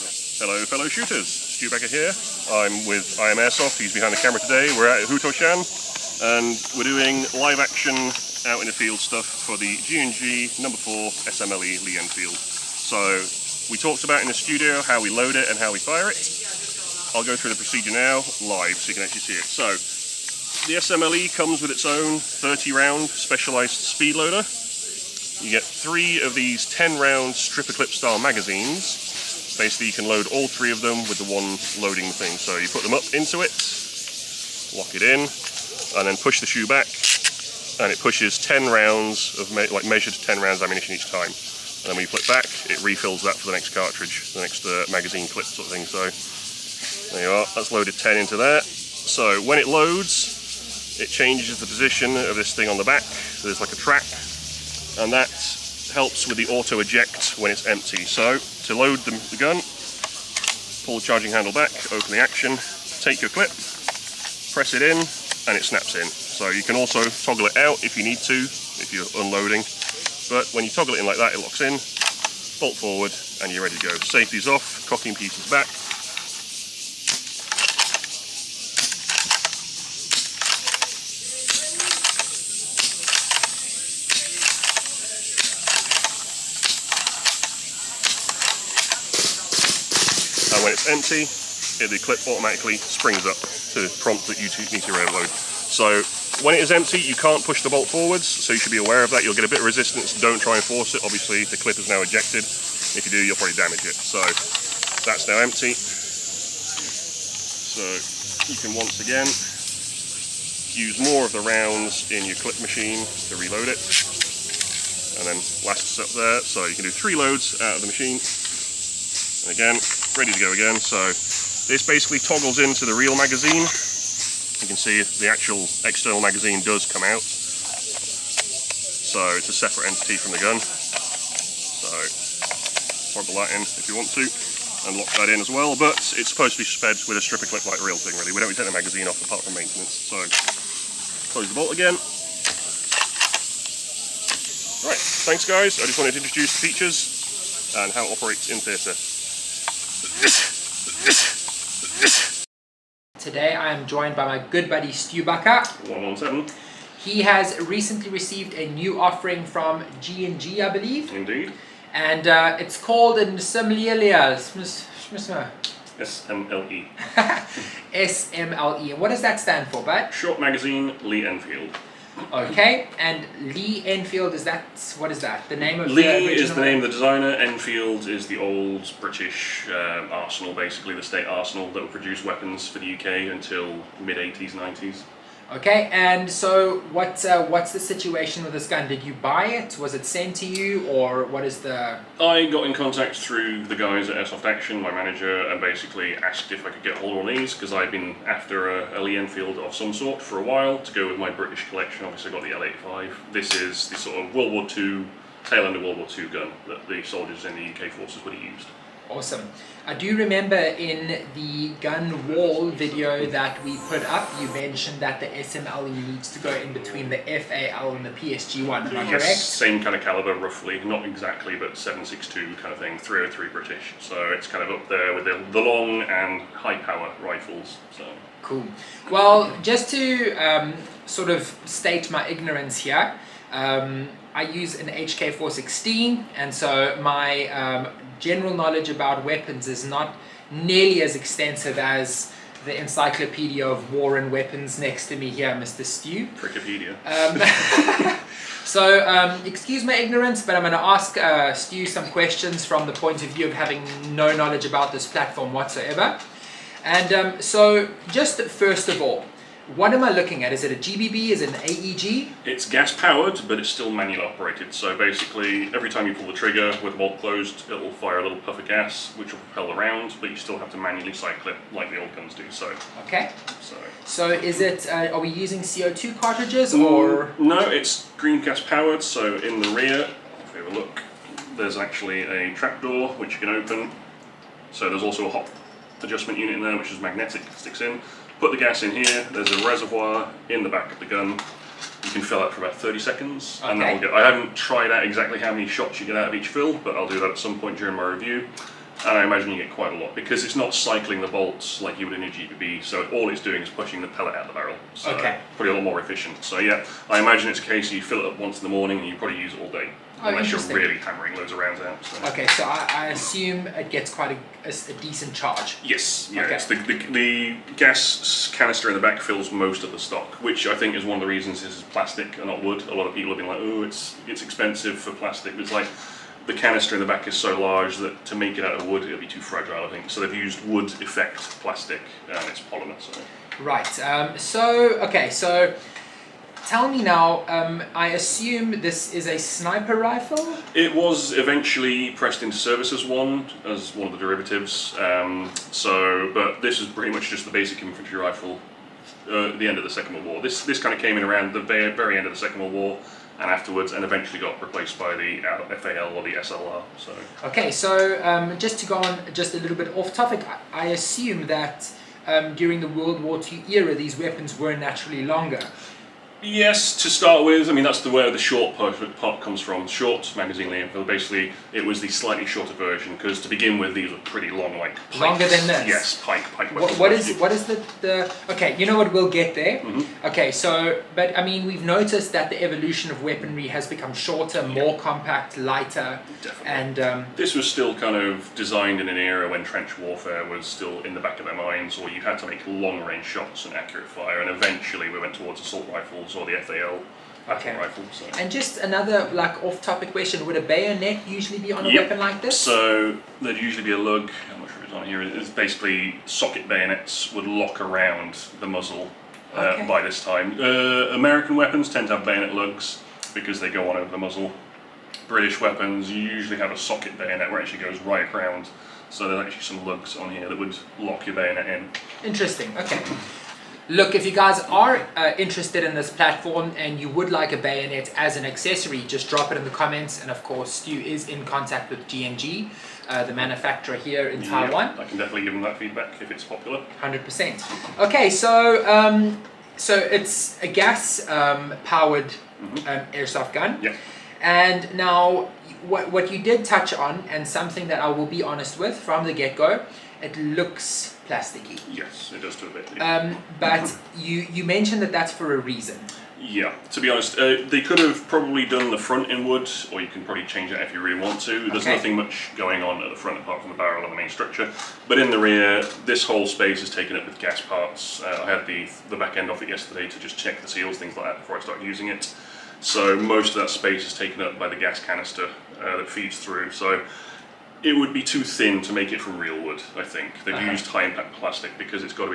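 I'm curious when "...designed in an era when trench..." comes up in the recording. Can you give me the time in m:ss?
6:28.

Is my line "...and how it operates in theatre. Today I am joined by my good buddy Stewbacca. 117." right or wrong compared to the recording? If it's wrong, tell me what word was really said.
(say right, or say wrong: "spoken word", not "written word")
right.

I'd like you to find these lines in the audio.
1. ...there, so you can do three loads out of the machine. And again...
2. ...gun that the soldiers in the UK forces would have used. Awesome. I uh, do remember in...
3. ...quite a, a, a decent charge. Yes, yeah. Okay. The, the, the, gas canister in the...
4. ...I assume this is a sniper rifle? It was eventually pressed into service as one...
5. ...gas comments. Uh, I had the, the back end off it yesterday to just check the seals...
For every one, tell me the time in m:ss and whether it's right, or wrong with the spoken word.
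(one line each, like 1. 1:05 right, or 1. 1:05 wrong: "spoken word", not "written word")
1. 1:56 right
2. 3:26 right
3. 5:14 right
4. 5:37 right
5. 7:47 wrong: "parts", not "comments".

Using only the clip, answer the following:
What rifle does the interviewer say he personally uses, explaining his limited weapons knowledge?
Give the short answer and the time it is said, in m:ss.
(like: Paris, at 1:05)
HK416, at 3:54.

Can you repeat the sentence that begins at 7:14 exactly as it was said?
I can definitely give them that feedback if it's popular.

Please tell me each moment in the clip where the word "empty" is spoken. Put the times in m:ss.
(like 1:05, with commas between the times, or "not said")
0:57, 1:30, 1:36, 1:45.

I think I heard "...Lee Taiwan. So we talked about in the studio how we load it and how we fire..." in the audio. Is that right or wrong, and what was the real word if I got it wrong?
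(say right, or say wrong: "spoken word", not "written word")
wrong: "Enfield", not "Taiwan".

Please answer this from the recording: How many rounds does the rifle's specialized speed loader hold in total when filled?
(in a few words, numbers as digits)
30.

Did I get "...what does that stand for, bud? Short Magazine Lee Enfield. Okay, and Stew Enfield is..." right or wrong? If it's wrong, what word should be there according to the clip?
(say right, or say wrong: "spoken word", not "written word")
wrong: "Lee", not "Stew".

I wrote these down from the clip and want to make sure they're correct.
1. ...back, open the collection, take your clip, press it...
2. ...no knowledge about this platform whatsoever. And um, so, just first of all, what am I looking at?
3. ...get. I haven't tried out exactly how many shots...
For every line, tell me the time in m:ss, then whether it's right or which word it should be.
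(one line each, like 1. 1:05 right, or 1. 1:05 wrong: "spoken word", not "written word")
1. 1:01 wrong: "action", not "collection"
2. 4:14 right
3. 4:53 right.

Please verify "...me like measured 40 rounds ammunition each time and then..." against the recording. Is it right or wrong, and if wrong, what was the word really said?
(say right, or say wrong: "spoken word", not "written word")
wrong: "10", not "40".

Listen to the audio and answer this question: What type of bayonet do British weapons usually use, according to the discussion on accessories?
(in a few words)
socket bayonet.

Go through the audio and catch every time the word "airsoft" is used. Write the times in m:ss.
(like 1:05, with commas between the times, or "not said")
0:03, 3:14, 7:23.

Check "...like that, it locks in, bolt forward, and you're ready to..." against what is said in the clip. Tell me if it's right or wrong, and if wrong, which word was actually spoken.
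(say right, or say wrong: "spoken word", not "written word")
right.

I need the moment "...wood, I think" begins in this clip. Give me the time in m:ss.
7:59.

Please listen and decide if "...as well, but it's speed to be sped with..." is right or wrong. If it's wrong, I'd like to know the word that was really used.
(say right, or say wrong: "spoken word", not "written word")
wrong: "supposed", not "speed".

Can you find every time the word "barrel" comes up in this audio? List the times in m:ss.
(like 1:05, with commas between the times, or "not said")
5:04, 7:43.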